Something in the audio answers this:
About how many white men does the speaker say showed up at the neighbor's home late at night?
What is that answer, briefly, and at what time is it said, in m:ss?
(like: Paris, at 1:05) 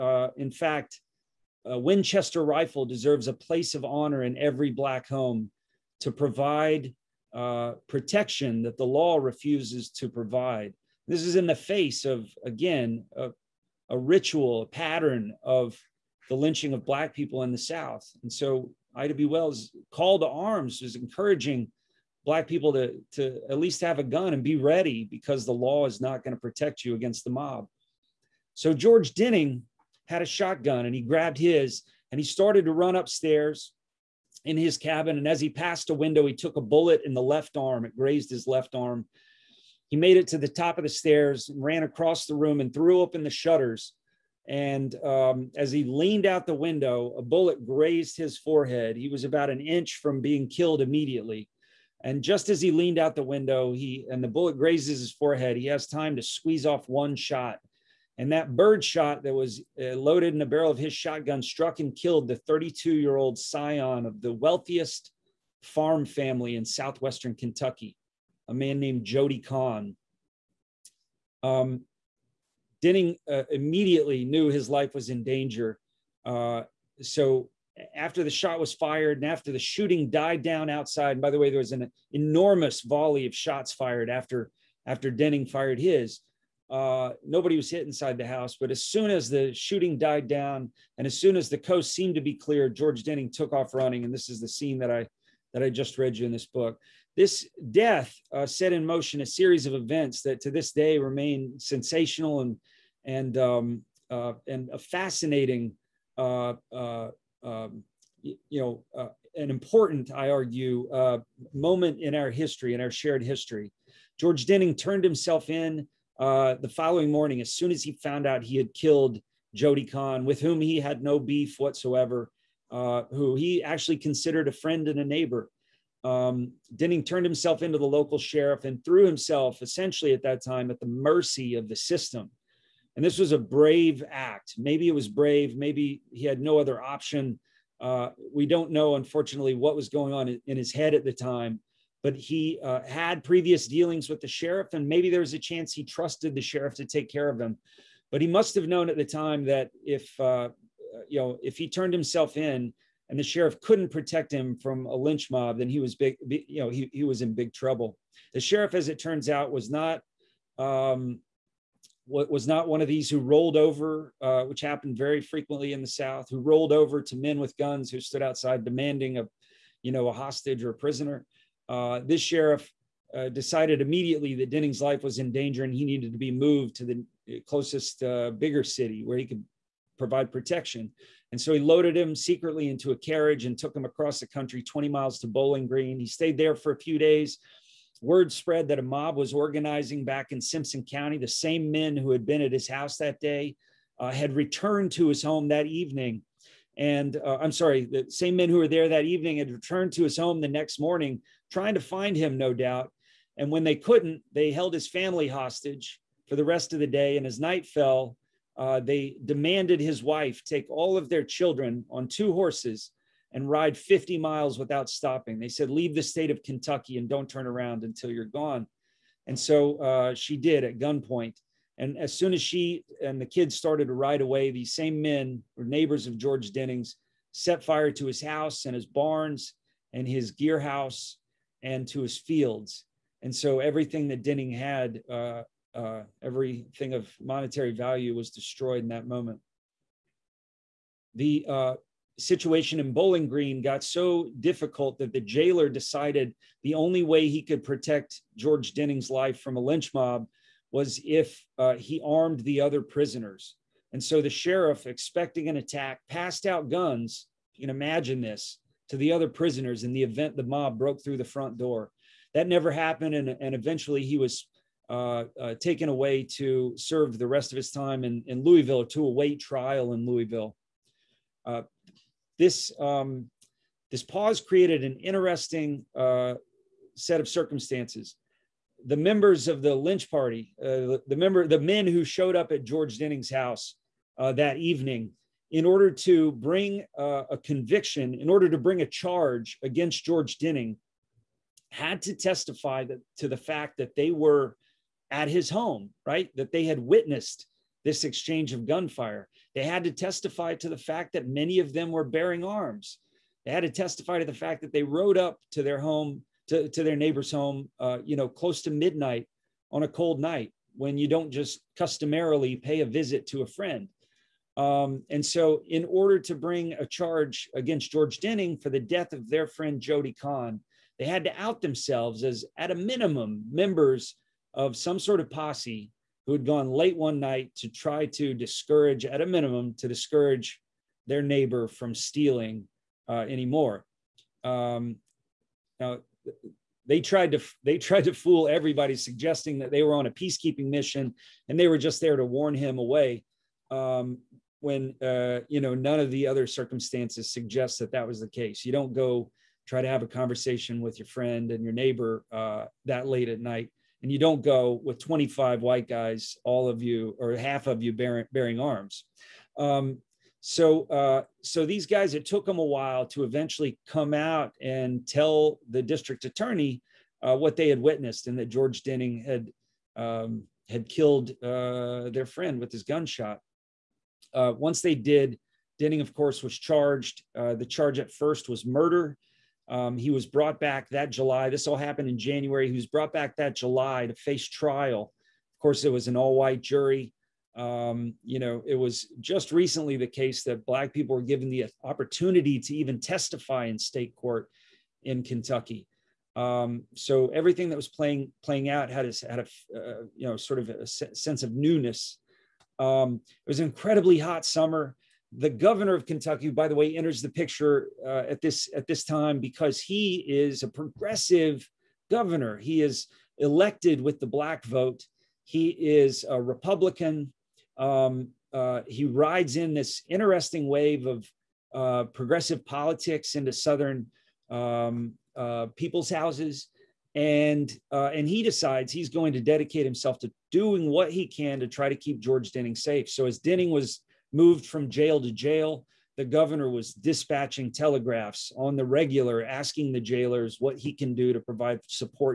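25, at 5:54.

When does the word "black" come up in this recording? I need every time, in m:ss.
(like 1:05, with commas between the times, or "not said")
0:04, 0:16, 0:22, 6:30, 6:54.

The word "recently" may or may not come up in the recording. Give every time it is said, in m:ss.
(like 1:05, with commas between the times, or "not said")
6:29.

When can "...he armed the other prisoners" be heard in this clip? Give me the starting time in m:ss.
4:11.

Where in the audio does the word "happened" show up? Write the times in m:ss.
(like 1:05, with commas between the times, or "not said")
2:44, 4:22, 6:21.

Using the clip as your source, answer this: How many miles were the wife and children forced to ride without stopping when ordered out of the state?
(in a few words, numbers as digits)
50.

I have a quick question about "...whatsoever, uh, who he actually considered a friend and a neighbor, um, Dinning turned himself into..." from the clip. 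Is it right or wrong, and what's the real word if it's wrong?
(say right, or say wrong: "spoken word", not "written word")
right.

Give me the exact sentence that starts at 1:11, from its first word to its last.
Um, Dinning uh, immediately knew his life was in danger.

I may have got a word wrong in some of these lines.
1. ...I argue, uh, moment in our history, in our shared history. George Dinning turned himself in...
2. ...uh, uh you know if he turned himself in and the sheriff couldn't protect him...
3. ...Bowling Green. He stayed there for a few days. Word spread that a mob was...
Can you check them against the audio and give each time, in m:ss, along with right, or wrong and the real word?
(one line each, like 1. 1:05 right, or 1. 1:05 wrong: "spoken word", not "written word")
1. 1:50 right
2. 2:30 right
3. 3:05 right.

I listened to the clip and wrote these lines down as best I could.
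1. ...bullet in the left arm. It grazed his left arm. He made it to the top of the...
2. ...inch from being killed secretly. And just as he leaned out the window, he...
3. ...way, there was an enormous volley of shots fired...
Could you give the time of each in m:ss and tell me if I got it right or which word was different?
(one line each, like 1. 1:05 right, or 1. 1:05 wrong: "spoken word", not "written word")
1. 0:36 right
2. 0:49 wrong: "immediately", not "secretly"
3. 1:21 right.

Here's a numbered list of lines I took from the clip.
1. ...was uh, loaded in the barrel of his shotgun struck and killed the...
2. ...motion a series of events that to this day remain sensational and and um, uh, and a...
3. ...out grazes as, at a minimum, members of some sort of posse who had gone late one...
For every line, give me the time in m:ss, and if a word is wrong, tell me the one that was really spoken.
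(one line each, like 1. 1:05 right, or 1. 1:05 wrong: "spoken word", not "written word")
1. 0:59 right
2. 1:38 right
3. 5:21 wrong: "themselves", not "grazes".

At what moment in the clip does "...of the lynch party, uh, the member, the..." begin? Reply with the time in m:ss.
4:39.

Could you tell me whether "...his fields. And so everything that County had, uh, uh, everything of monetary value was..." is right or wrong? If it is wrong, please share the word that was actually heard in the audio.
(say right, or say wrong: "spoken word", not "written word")
wrong: "Dinning", not "County".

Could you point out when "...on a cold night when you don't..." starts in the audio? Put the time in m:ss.
5:09.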